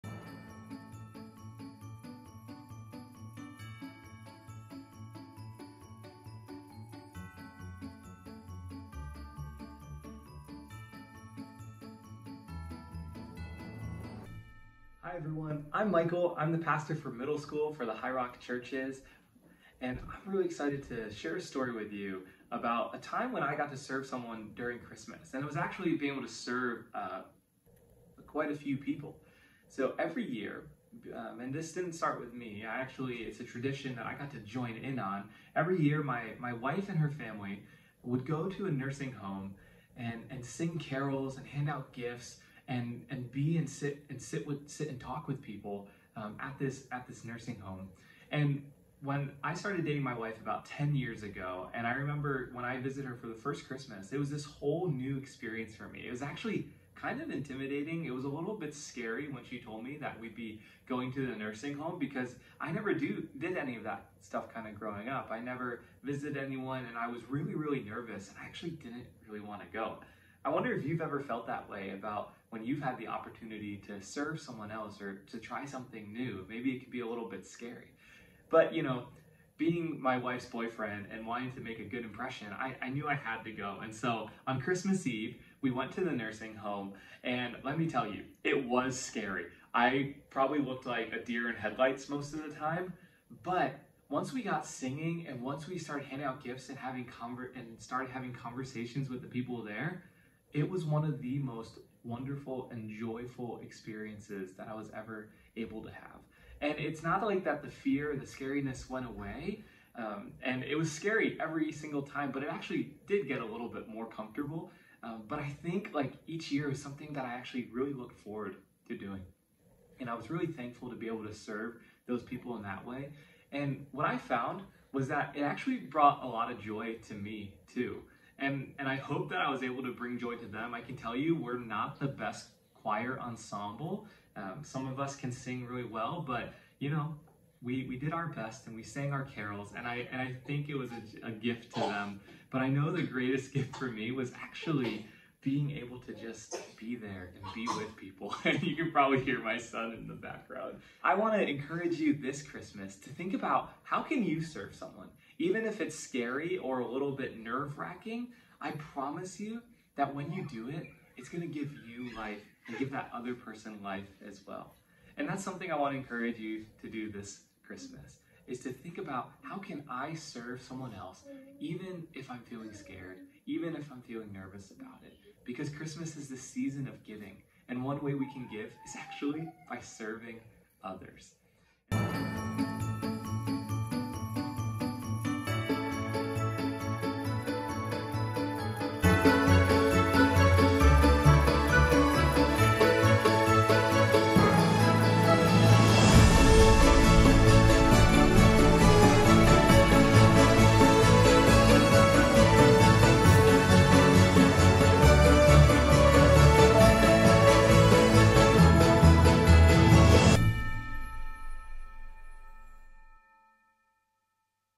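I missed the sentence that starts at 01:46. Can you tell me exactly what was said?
And it's not like that the fear the scariness went away.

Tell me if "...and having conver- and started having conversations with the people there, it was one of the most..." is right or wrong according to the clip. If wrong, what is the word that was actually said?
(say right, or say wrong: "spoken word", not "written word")
right.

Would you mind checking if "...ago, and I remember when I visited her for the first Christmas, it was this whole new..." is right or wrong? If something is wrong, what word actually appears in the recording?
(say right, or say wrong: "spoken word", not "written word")
right.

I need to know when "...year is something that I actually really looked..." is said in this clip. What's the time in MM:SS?
01:56.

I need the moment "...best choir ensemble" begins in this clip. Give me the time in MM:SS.
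02:12.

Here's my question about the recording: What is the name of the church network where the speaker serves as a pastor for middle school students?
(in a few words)
Highrock Churches.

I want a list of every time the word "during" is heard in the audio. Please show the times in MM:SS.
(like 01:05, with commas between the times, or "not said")
00:24.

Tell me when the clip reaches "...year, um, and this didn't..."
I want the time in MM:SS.
00:30.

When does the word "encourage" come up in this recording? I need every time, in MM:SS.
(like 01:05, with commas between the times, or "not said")
02:31, 02:45.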